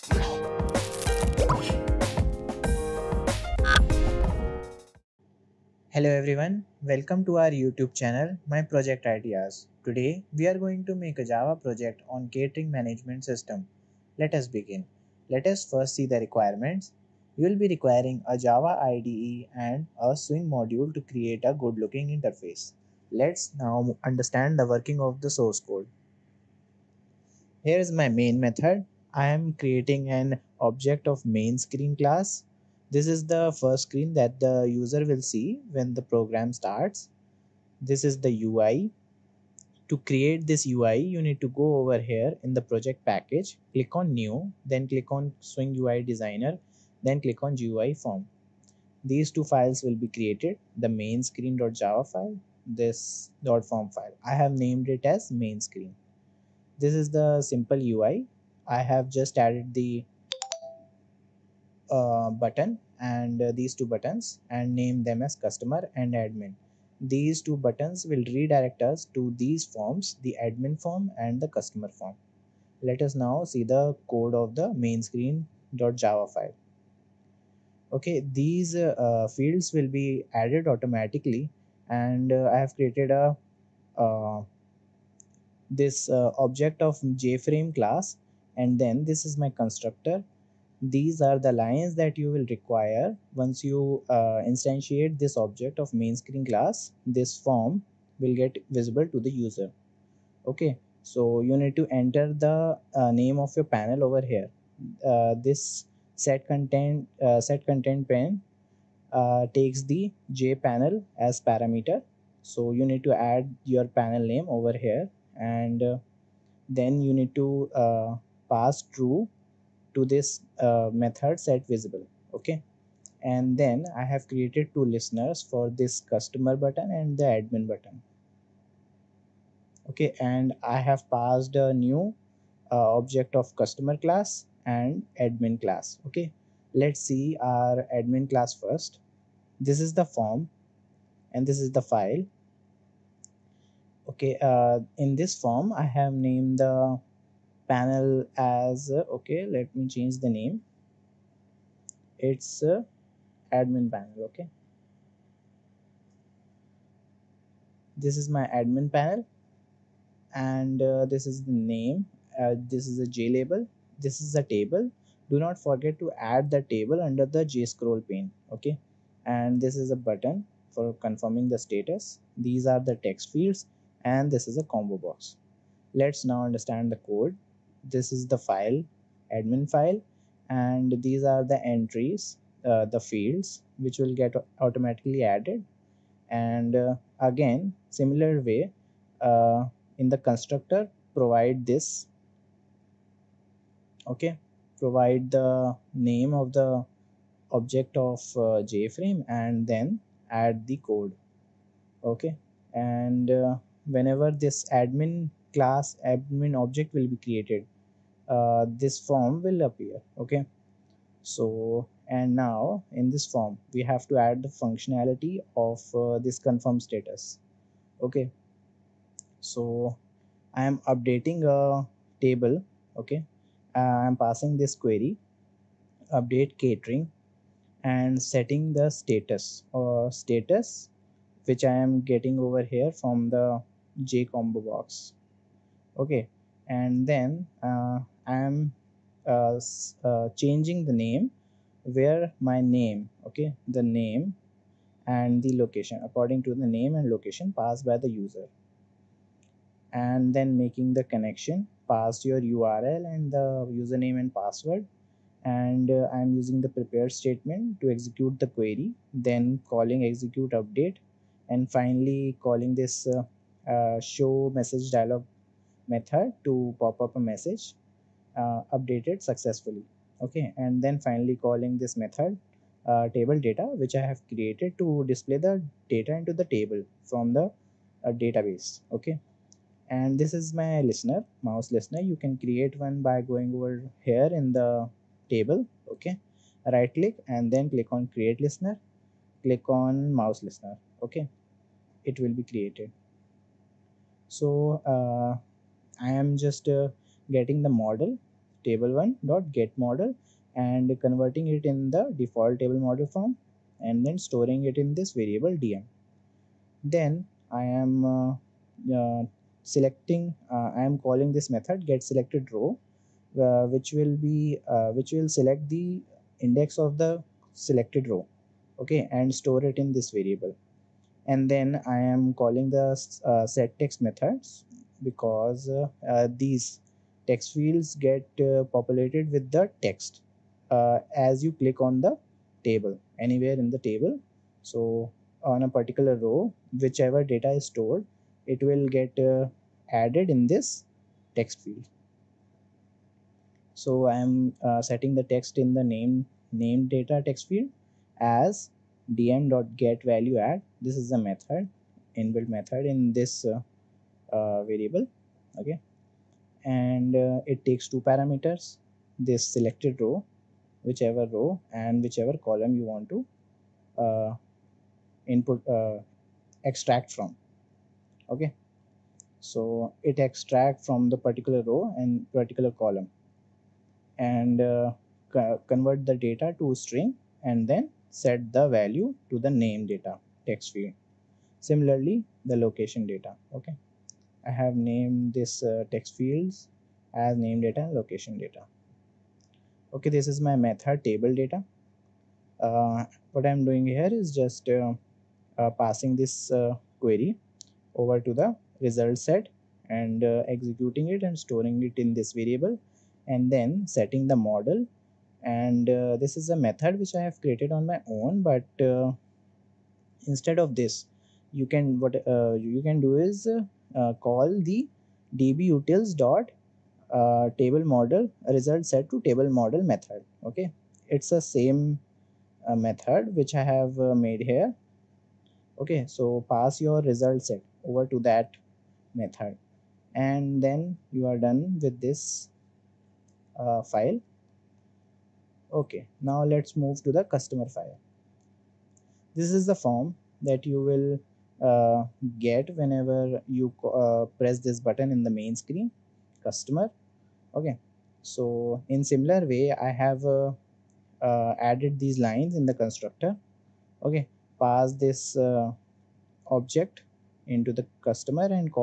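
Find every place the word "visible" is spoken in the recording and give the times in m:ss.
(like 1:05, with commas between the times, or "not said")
1:38, 2:01.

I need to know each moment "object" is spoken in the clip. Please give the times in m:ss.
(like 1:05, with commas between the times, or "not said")
0:30, 1:26, 1:35, 2:12, 3:17, 3:26, 7:36.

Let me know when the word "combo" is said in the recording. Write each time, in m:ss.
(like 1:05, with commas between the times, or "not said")
2:54, 3:54.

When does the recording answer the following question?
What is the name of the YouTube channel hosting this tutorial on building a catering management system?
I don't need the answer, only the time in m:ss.
0:08.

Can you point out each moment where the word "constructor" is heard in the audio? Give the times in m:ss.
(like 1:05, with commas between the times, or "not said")
1:29, 3:10, 7:32.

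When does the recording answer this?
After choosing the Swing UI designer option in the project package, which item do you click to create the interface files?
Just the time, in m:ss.
0:47.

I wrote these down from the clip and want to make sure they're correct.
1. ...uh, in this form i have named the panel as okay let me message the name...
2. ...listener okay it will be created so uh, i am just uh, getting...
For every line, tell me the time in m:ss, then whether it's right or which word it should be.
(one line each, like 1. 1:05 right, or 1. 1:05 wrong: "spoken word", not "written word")
1. 2:24 wrong: "change", not "message"
2. 4:50 right.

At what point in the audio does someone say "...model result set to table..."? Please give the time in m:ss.
6:57.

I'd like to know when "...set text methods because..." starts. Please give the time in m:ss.
5:23.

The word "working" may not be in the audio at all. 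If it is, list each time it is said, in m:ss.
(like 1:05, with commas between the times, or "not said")
0:24.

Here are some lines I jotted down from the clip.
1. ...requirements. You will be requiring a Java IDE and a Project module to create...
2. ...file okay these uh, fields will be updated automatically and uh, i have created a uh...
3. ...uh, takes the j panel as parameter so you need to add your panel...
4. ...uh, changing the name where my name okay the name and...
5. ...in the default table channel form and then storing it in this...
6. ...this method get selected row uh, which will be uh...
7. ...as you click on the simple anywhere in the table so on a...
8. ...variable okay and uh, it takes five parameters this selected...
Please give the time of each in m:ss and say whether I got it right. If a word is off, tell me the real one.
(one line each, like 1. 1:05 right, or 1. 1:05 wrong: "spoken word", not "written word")
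1. 0:16 wrong: "Swing", not "Project"
2. 1:16 wrong: "added", not "updated"
3. 1:49 right
4. 4:00 right
5. 5:01 wrong: "model", not "channel"
6. 5:11 right
7. 5:31 wrong: "table", not "simple"
8. 5:54 wrong: "two", not "five".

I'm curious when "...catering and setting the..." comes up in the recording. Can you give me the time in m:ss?
3:46.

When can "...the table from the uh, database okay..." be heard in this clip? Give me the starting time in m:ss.
4:36.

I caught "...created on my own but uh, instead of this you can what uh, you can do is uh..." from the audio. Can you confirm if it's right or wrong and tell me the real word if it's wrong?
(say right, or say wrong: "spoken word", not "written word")
right.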